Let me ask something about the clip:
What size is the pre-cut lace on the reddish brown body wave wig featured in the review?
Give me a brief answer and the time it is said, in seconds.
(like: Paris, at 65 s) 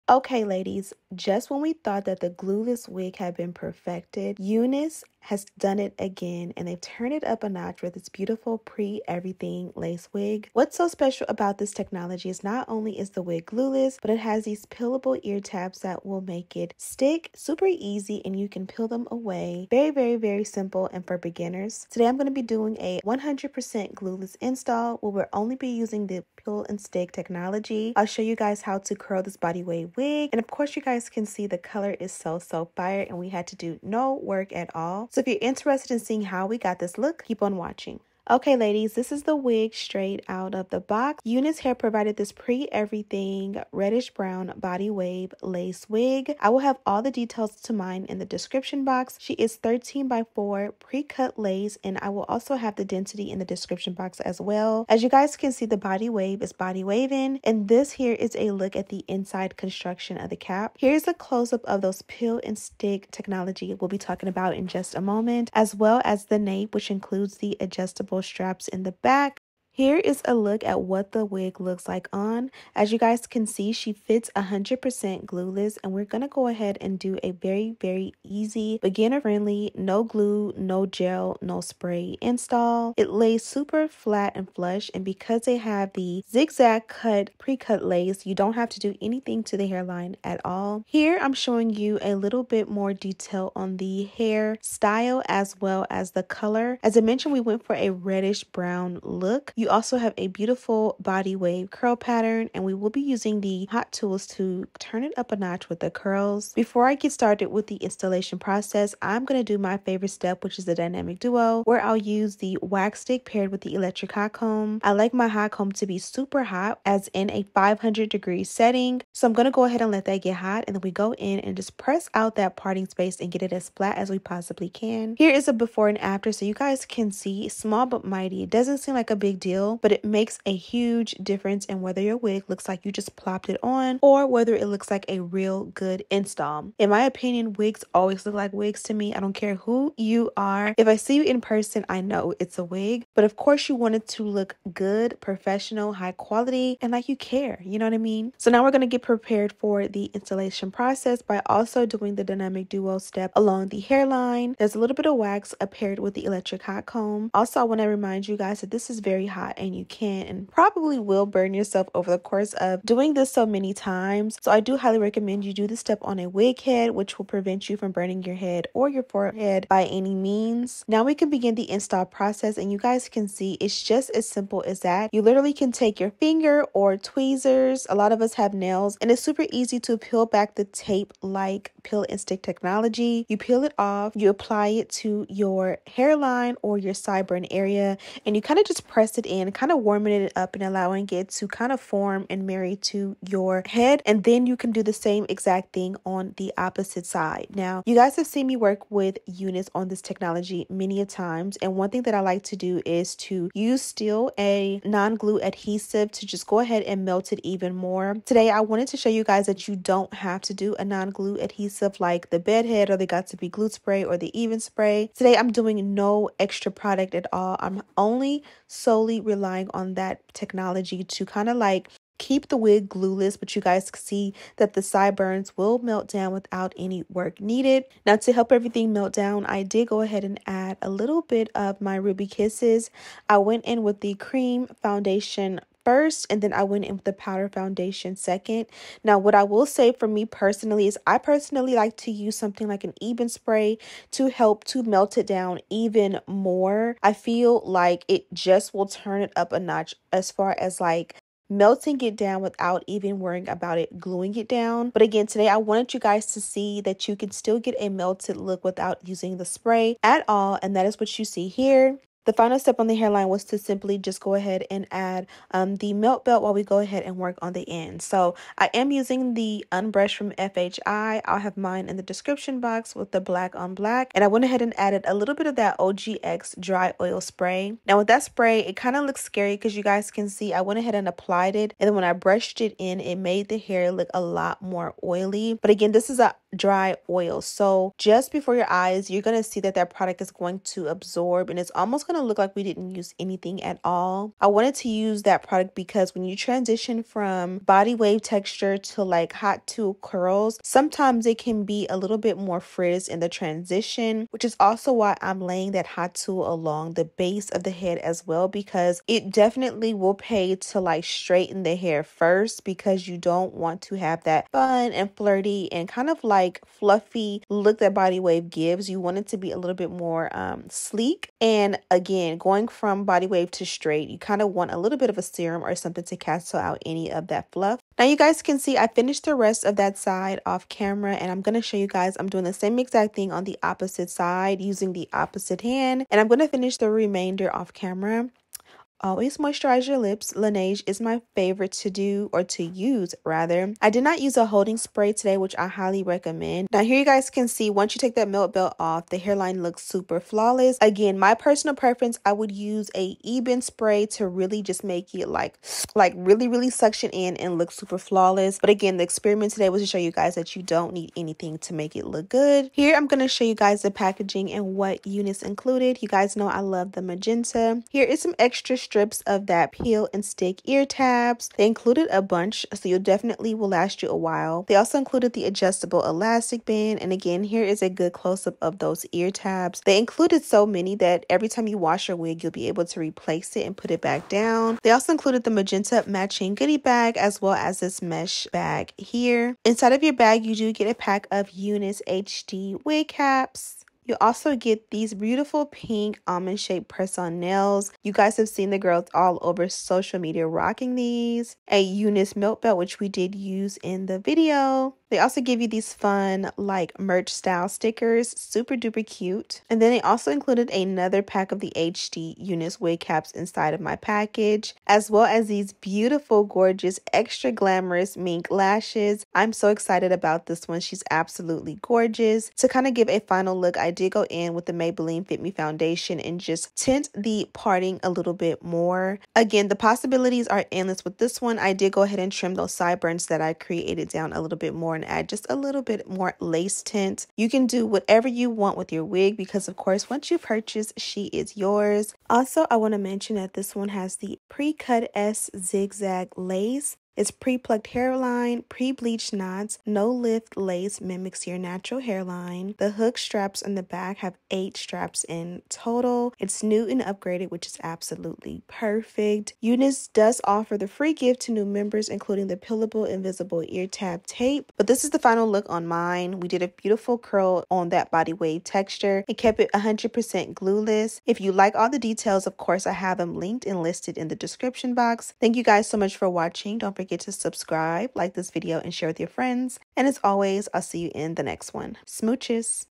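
13 by 4, at 49 s.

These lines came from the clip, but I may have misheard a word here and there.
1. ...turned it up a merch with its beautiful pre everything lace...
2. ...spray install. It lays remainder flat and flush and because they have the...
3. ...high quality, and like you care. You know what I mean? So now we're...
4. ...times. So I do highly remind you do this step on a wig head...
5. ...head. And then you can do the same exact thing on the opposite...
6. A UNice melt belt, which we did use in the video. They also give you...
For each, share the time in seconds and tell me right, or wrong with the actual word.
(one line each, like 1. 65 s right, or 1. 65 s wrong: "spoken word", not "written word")
1. 6 s wrong: "notch", not "merch"
2. 81 s wrong: "super", not "remainder"
3. 145 s right
4. 163 s wrong: "recommend", not "remind"
5. 193 s right
6. 401 s right.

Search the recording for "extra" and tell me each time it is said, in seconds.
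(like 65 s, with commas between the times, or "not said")
216 s, 368 s, 417 s.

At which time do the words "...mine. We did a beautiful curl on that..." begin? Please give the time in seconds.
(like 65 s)
465 s.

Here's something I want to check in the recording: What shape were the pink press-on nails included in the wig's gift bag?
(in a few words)
Almond.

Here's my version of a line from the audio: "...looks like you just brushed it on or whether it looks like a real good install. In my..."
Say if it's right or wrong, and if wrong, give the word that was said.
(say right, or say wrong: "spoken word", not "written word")
wrong: "plopped", not "brushed".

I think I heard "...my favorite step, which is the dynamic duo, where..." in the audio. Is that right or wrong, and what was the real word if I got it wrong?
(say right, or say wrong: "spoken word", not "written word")
right.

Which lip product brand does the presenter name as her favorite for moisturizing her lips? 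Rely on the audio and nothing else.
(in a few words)
Laneige.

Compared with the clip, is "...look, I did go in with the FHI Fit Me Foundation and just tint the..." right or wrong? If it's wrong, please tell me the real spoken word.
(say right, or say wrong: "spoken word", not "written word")
wrong: "Maybelline", not "FHI".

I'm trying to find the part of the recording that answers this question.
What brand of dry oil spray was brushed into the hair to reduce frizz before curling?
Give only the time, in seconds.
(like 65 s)
275 s.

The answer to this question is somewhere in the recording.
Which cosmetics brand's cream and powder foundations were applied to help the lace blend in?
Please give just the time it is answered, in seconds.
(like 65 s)
231 s.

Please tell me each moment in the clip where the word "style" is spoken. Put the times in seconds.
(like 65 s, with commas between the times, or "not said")
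94 s, 407 s.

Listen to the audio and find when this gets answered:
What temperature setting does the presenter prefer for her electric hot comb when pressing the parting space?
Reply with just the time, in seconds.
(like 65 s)
117 s.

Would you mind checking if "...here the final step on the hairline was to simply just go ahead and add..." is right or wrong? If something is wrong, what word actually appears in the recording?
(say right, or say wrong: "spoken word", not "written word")
right.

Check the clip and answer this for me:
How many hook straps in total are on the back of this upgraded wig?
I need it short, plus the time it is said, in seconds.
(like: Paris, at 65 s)
8, at 454 s.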